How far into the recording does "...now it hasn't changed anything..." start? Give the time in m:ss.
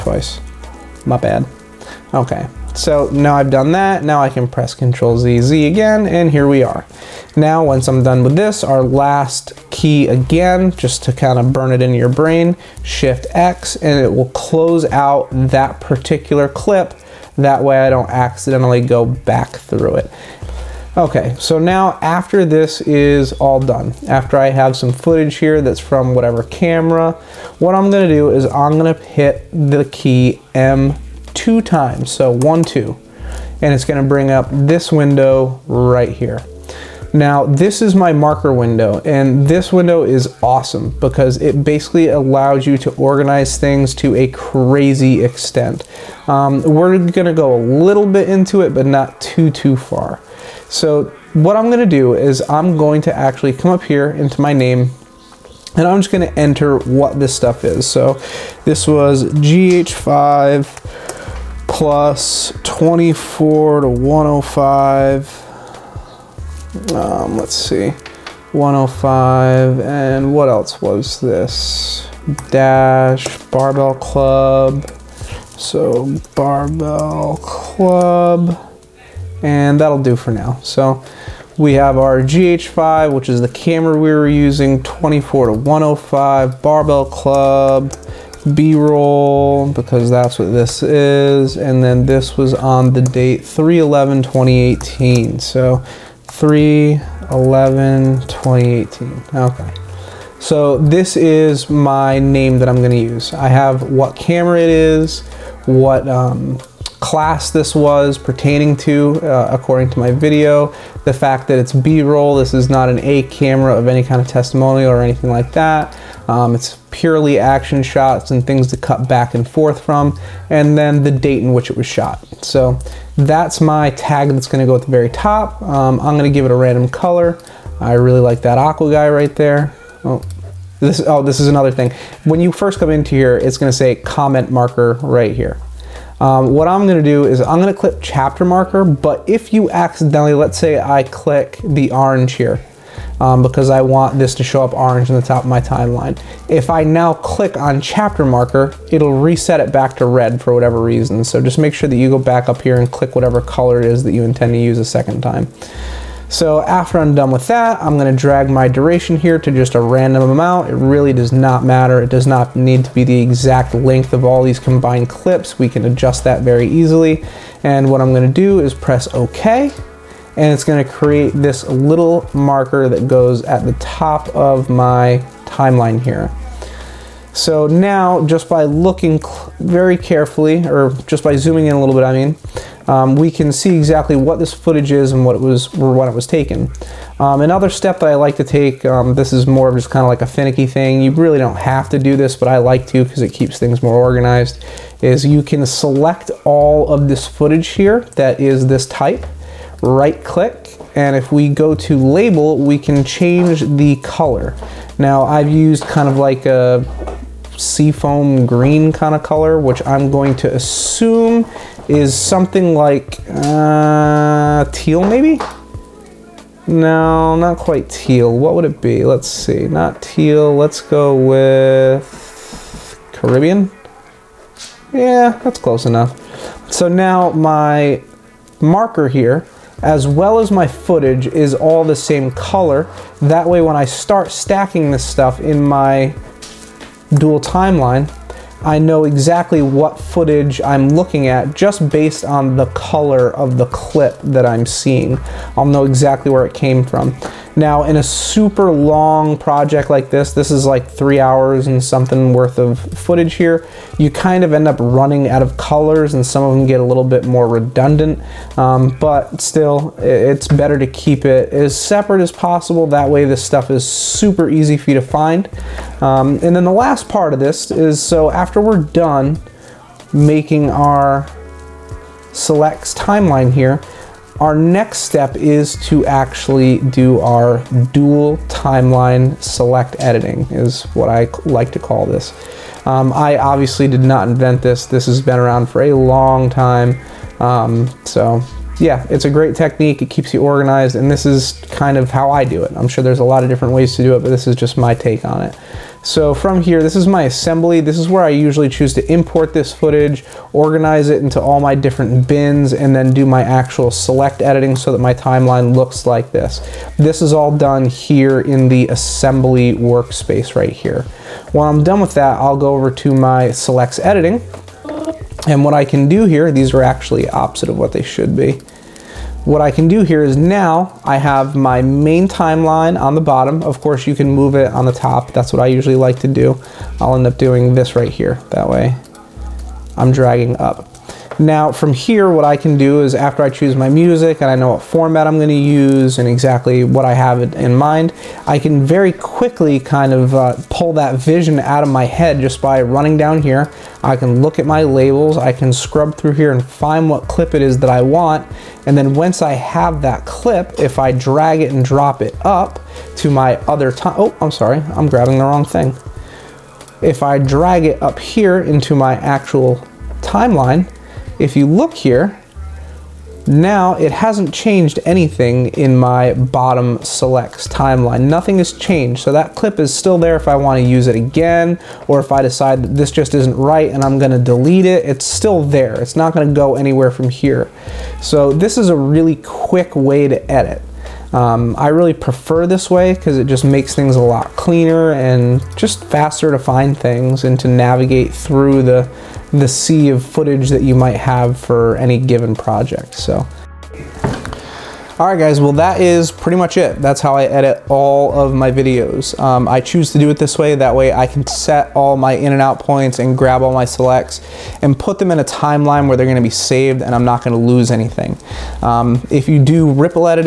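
6:03.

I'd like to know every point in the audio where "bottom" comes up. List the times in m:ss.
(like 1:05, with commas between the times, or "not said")
5:23, 6:06.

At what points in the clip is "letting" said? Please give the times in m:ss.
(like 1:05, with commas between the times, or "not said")
not said.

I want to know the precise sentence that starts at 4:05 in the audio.
I'll know exactly where it came from.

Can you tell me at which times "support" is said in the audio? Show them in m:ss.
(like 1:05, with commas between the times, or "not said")
not said.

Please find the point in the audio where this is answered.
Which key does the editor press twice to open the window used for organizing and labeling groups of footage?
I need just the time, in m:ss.
0:30.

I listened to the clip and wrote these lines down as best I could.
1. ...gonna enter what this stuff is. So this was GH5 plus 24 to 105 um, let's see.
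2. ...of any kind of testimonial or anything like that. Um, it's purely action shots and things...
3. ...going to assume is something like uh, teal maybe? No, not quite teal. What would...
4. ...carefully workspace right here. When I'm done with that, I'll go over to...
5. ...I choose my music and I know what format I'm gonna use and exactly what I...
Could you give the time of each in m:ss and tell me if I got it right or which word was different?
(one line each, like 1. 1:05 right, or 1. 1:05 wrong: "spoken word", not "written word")
1. 0:56 right
2. 1:53 right
3. 3:30 right
4. 5:08 wrong: "assembly", not "carefully"
5. 5:33 right.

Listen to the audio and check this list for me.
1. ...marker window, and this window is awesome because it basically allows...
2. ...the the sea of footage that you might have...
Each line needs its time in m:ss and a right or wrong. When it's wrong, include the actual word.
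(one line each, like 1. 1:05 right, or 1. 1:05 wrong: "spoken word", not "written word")
1. 0:38 right
2. 6:28 right.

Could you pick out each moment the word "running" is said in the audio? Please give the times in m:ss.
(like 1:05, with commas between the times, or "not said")
4:14, 5:42.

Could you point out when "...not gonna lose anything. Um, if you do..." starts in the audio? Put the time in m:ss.
6:47.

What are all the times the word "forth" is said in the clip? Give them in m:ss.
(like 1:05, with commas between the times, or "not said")
1:59.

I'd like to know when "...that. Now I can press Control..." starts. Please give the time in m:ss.
0:03.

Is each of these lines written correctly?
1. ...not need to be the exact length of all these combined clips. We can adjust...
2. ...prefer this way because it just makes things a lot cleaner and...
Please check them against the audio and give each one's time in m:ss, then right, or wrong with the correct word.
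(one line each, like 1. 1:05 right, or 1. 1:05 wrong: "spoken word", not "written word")
1. 2:42 right
2. 6:22 right.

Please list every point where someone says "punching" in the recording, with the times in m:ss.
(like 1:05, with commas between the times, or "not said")
not said.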